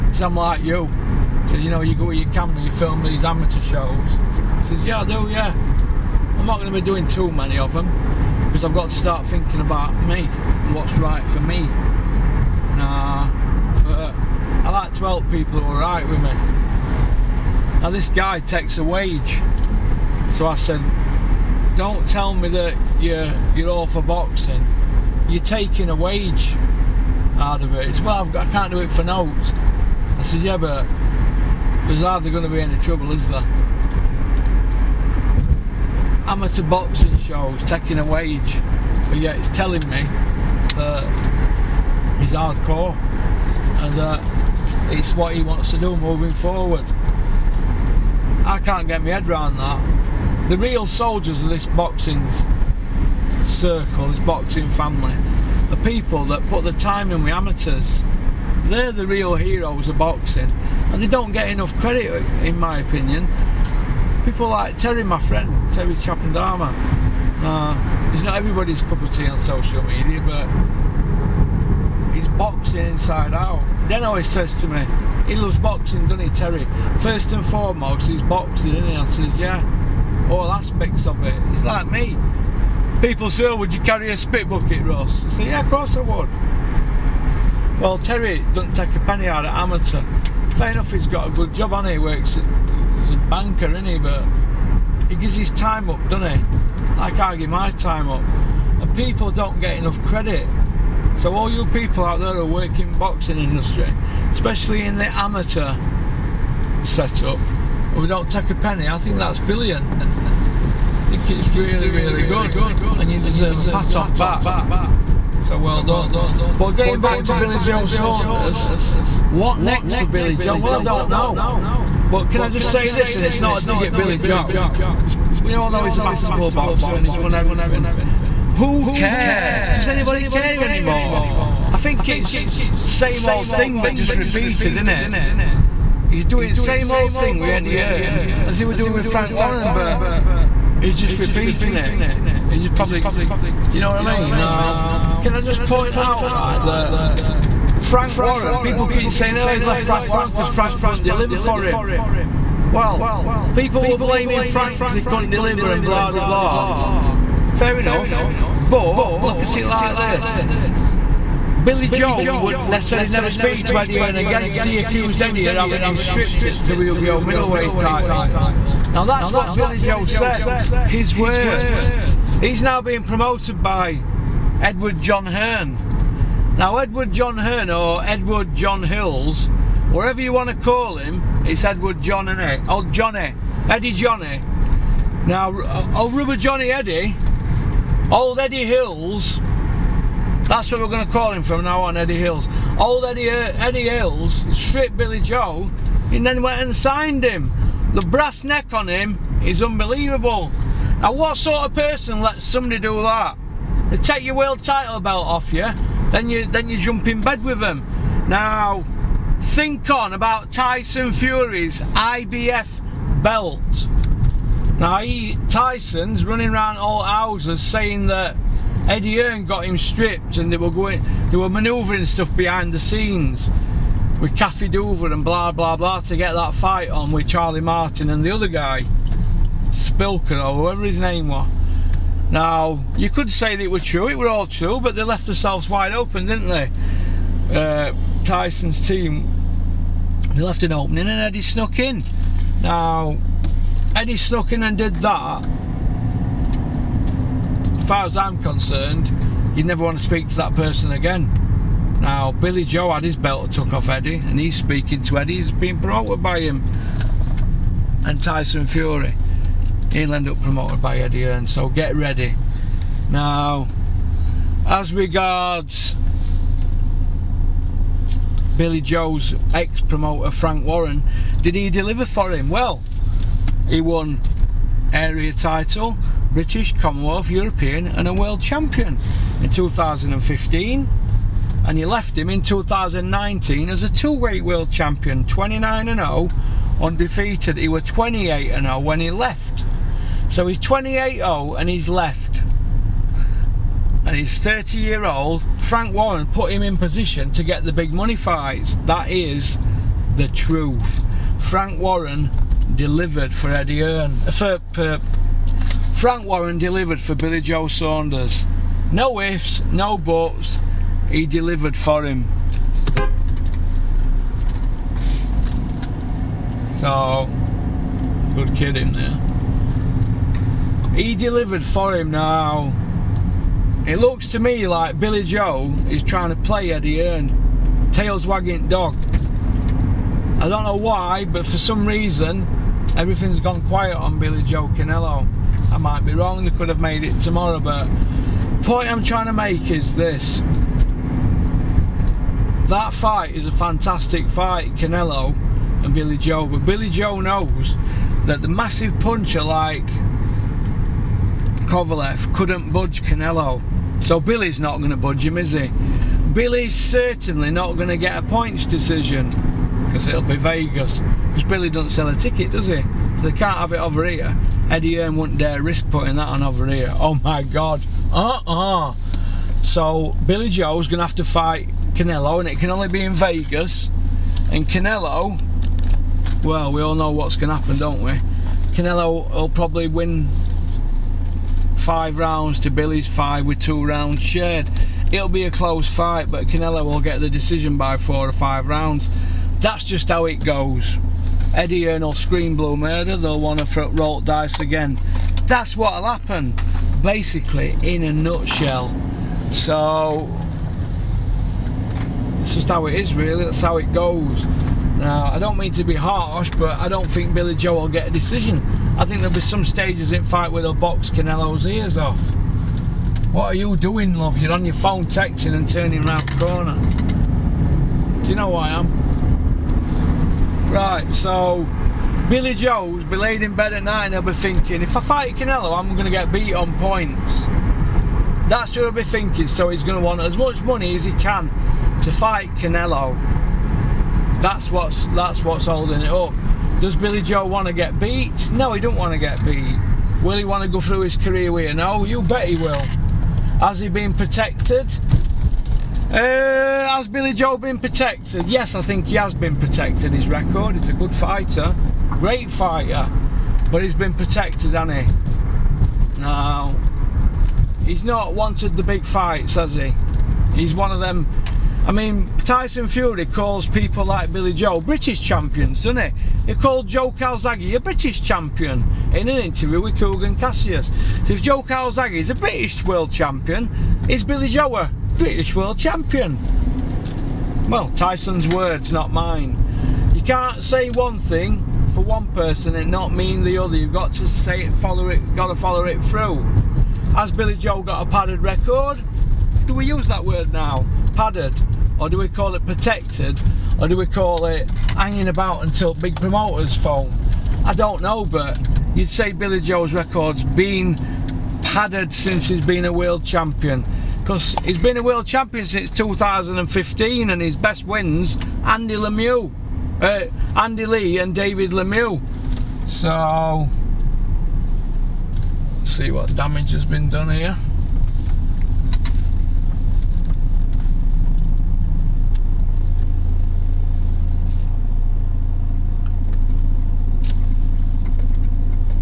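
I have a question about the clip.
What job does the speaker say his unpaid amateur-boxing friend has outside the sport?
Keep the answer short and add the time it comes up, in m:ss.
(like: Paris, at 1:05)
Banker, at 1:33.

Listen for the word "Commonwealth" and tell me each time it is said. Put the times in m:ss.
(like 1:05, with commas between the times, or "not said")
4:36.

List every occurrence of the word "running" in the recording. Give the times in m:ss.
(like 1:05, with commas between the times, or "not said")
3:36.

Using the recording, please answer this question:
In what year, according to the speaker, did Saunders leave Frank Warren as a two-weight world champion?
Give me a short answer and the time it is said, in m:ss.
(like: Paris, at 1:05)
2019, at 4:42.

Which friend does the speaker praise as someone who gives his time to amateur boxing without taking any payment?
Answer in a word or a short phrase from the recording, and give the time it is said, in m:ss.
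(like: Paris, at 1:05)
Terry Chapandama, at 1:05.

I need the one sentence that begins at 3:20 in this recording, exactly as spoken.
Now what sort of person lets somebody do that?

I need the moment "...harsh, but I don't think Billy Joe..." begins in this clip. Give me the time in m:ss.
6:45.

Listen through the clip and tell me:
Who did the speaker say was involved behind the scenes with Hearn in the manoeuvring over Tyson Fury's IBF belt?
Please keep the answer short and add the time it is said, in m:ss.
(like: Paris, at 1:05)
Kathy Duva, at 3:44.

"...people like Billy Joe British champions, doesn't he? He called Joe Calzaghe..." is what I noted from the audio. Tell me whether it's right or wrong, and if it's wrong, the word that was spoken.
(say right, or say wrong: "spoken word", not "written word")
right.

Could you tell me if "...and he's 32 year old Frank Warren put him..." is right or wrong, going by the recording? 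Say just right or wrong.
wrong.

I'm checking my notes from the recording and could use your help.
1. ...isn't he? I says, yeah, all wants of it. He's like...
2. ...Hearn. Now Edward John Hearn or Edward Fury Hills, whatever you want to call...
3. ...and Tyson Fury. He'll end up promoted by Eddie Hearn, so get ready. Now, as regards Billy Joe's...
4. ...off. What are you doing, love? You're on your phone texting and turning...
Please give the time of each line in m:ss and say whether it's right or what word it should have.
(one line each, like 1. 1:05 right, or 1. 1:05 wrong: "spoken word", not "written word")
1. 1:18 wrong: "aspects", not "wants"
2. 2:55 wrong: "John", not "Fury"
3. 4:18 right
4. 6:51 right.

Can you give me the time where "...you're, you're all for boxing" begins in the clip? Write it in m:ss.
0:23.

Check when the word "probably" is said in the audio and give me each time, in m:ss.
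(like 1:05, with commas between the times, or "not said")
2:22, 6:19.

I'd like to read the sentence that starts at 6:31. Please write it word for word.
Eddie Hearn or Screen Blue Murder, they'll want to roll dice again.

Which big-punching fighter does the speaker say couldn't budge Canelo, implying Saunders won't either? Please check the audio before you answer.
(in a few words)
Kovalev.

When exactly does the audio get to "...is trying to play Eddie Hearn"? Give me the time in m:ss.
5:25.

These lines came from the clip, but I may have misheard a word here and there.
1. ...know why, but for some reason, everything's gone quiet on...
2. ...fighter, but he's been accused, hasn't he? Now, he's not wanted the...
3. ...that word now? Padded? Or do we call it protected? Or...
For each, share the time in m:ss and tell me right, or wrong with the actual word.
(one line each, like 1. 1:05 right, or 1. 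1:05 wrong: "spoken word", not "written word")
1. 5:30 right
2. 7:32 wrong: "protected", not "accused"
3. 8:10 right.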